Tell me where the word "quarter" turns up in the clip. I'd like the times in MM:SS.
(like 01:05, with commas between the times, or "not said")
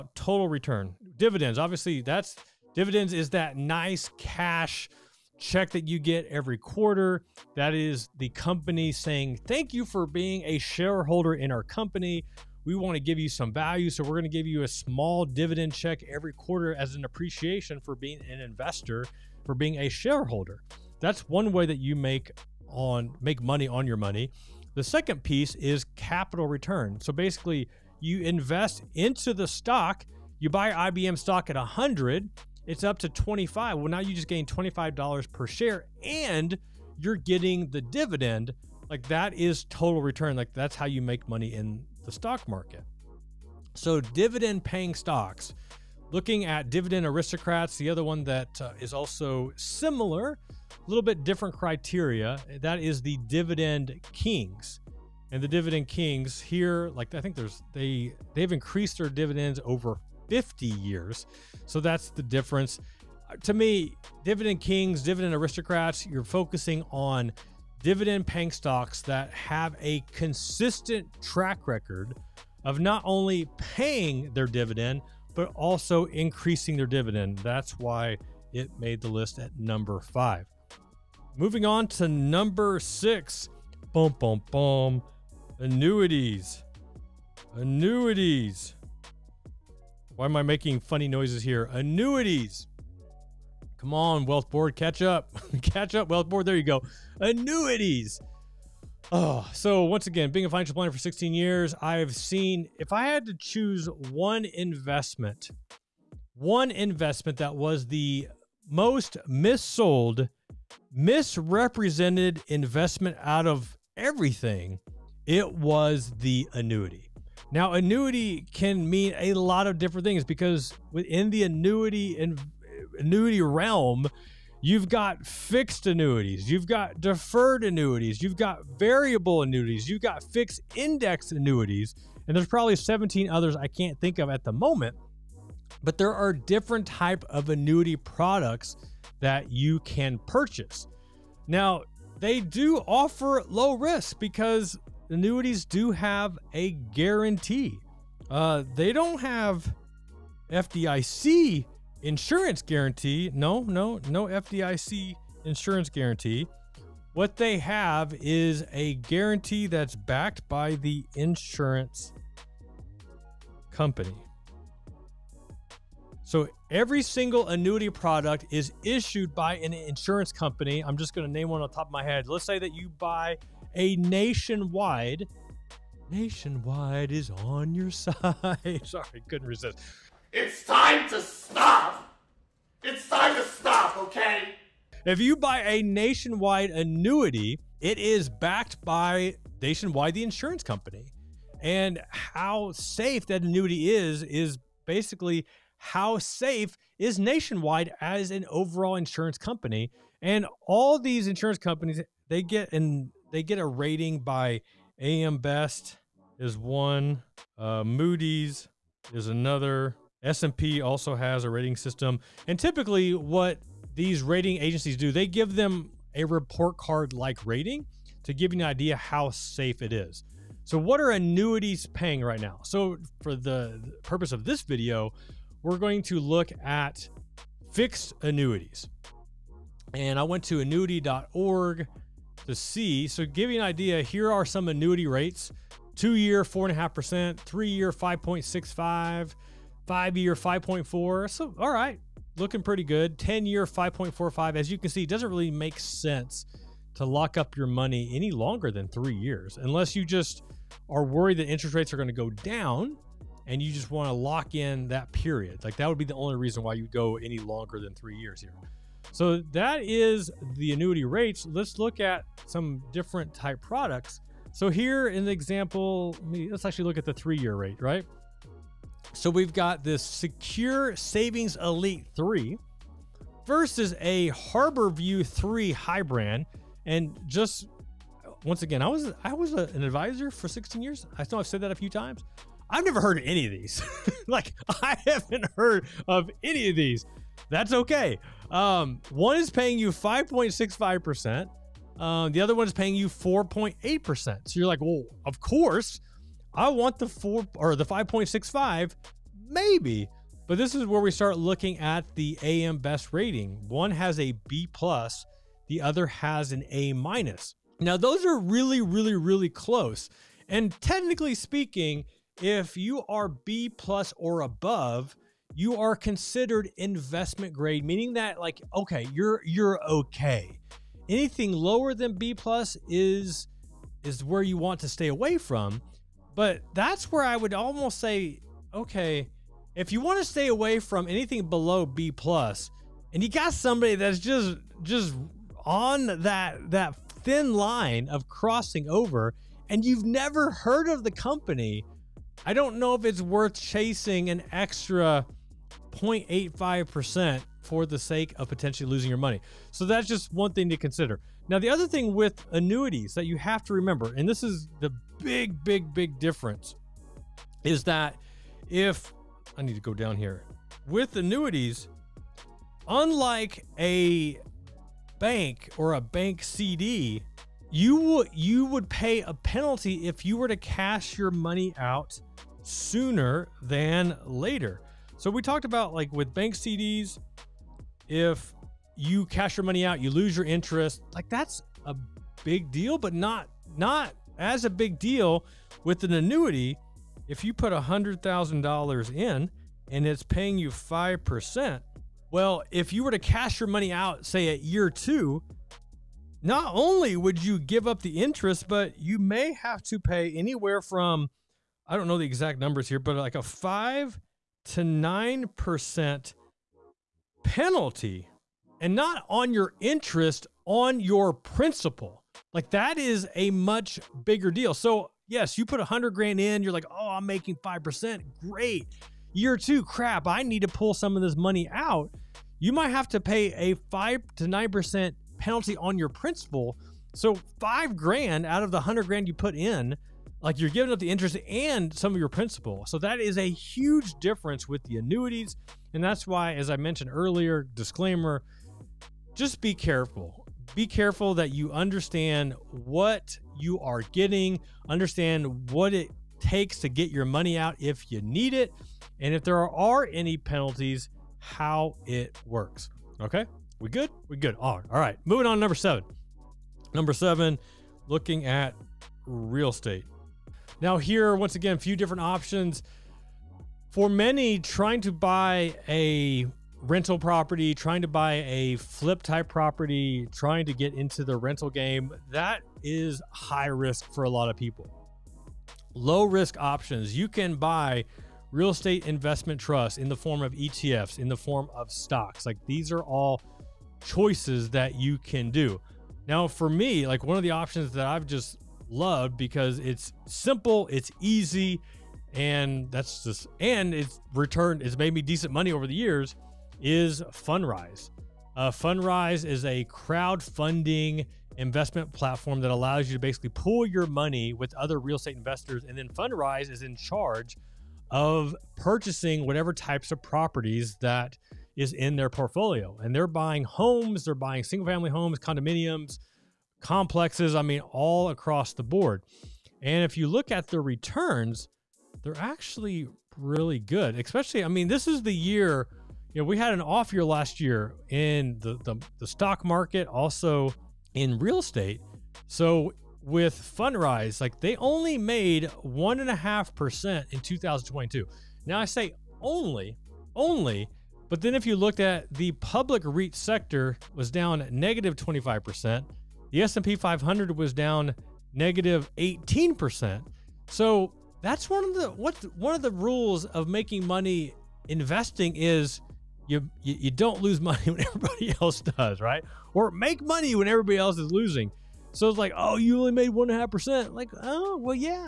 00:06, 00:16.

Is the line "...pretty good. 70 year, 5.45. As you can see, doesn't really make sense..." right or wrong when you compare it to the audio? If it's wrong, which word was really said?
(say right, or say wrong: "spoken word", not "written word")
wrong: "10", not "70".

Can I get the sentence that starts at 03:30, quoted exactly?
S&P also has a rating system.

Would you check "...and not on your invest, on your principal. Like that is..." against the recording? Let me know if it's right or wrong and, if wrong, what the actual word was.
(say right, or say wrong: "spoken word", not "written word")
wrong: "interest", not "invest".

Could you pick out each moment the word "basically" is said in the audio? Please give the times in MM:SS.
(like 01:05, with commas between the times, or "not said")
00:27, 03:14, 08:23.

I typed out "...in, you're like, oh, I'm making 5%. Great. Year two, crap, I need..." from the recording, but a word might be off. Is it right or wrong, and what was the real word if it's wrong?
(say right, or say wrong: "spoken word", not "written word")
right.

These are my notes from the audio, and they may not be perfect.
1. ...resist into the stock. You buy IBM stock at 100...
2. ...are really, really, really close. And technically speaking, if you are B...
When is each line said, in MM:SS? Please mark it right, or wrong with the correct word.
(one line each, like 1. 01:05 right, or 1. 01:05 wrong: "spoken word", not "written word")
1. 00:28 wrong: "invest", not "resist"
2. 05:08 right.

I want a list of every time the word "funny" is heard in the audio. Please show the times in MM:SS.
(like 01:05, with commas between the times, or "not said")
01:30.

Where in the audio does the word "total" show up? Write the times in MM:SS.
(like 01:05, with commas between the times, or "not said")
00:00, 00:39.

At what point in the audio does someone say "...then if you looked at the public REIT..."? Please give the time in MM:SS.
09:01.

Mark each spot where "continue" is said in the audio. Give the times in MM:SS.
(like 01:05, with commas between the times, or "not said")
not said.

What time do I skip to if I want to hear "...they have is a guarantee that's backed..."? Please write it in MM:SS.
02:37.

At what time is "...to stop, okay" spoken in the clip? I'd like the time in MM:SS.
03:03.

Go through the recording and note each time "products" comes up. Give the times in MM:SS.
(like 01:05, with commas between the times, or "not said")
02:17, 02:47, 04:23.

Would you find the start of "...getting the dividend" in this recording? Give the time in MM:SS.
00:37.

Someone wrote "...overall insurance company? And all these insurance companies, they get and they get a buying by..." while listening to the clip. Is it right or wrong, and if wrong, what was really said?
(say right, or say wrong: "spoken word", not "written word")
wrong: "rating", not "buying".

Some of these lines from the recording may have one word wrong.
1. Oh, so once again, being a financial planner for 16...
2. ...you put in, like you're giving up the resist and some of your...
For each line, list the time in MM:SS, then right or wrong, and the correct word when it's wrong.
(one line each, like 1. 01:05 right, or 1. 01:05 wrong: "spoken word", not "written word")
1. 01:39 right
2. 07:09 wrong: "interest", not "resist".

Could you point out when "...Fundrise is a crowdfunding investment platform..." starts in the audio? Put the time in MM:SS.
08:18.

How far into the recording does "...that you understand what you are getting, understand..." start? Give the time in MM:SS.
07:21.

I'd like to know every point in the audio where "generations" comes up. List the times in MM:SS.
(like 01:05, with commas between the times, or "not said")
not said.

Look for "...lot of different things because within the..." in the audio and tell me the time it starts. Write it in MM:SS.
01:59.